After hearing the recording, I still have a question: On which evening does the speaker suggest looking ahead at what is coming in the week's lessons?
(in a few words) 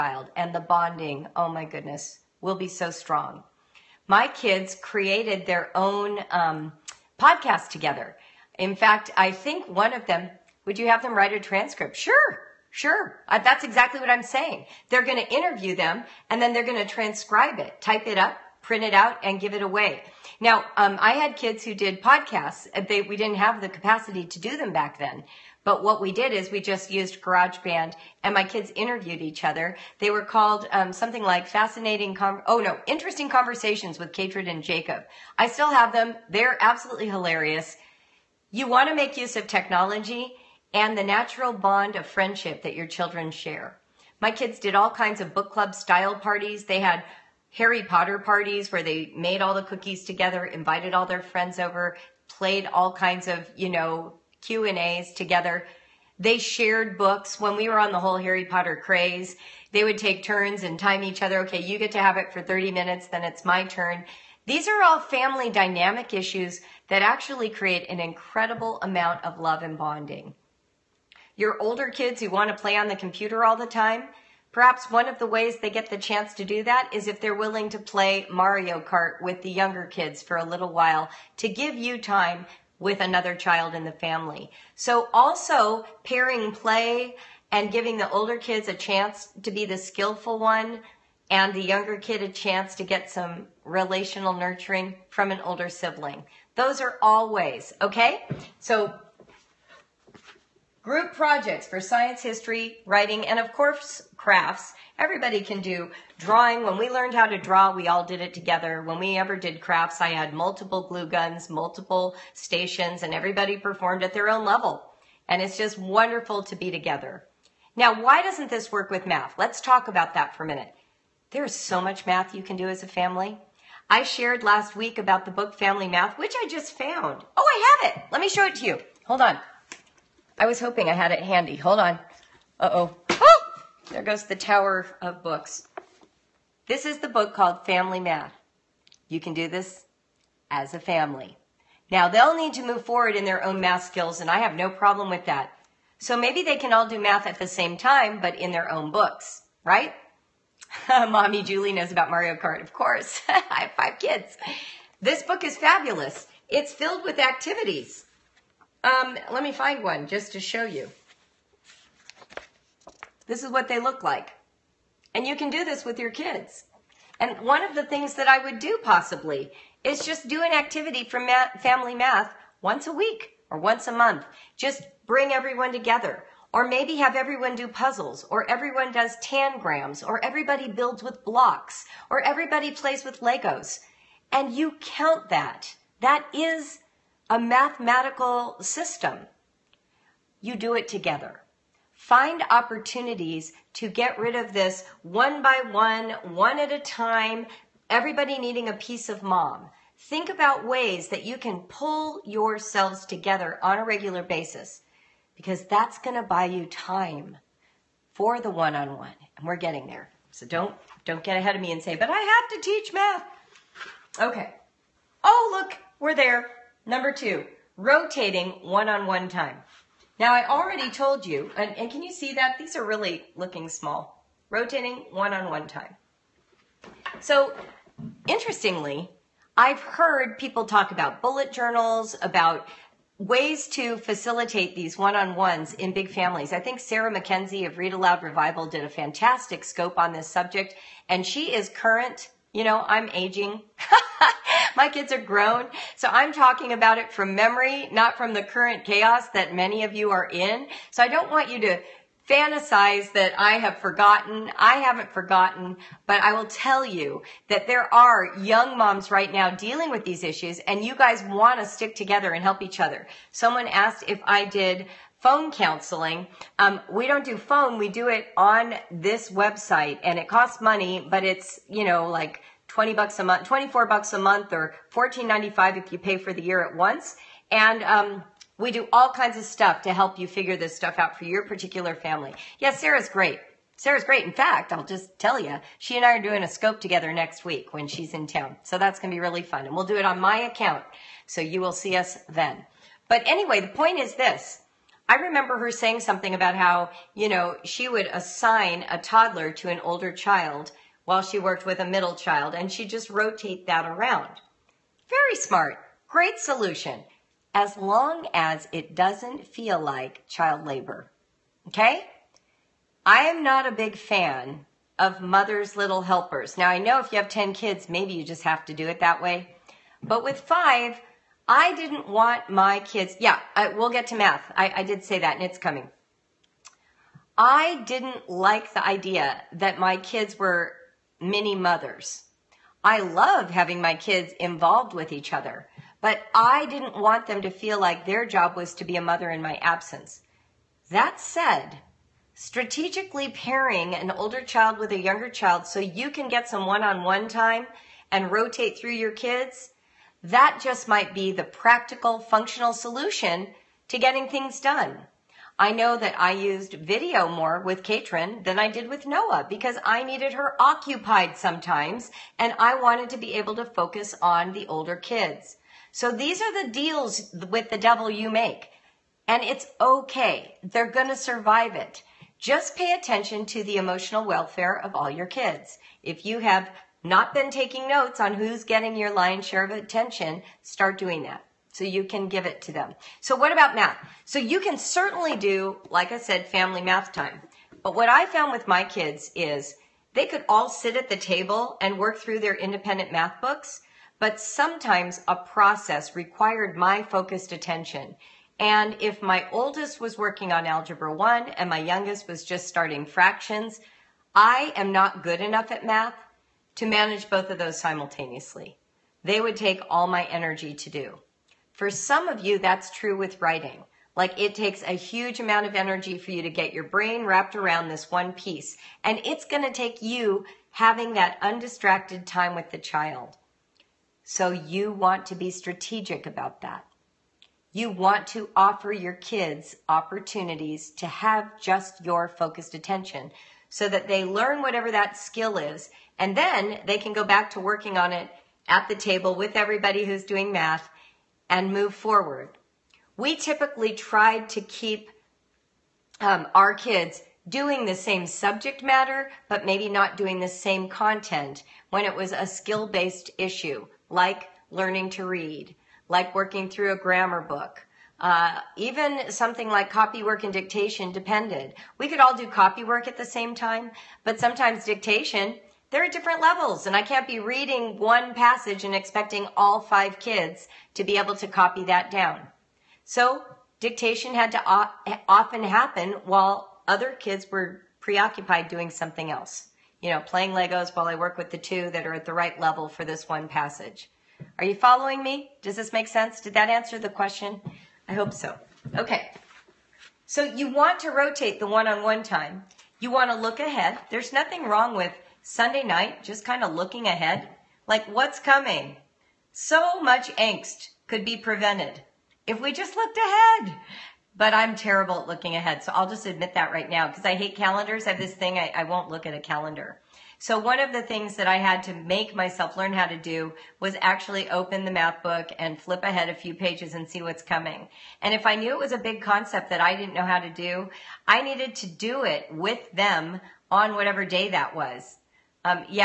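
Sunday night.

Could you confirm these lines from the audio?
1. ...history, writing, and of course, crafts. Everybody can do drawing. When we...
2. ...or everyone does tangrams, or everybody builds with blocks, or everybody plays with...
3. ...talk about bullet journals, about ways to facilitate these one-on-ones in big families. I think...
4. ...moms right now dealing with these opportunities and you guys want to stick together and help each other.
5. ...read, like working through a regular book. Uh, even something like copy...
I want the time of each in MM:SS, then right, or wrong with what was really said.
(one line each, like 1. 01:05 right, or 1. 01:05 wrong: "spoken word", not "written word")
1. 01:42 right
2. 02:58 right
3. 03:50 right
4. 04:18 wrong: "issues", not "opportunities"
5. 07:35 wrong: "grammar", not "regular".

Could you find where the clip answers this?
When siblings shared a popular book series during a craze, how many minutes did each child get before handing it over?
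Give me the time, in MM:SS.
01:02.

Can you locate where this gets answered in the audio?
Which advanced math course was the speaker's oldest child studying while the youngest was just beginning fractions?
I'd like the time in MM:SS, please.
06:40.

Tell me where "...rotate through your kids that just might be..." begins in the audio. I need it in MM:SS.
05:48.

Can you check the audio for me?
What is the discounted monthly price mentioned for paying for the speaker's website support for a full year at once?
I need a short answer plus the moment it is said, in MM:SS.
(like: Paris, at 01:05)
$14.95, at 04:34.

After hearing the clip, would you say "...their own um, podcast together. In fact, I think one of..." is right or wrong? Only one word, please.
right.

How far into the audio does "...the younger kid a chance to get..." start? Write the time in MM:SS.
01:31.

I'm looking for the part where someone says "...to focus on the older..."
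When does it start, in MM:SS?
06:03.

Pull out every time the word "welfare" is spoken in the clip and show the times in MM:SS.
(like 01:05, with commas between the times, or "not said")
06:14.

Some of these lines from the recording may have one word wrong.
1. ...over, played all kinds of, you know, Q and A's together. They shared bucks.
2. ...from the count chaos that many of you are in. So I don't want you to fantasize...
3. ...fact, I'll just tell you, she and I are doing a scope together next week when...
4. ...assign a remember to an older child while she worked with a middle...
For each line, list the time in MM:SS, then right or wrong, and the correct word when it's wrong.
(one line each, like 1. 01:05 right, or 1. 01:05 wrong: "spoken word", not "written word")
1. 00:51 wrong: "books", not "bucks"
2. 04:08 wrong: "current", not "count"
3. 04:44 right
4. 04:58 wrong: "toddler", not "remember".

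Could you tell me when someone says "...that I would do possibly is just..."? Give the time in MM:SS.
02:48.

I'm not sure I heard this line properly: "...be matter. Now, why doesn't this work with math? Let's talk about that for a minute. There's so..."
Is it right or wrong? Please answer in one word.
wrong.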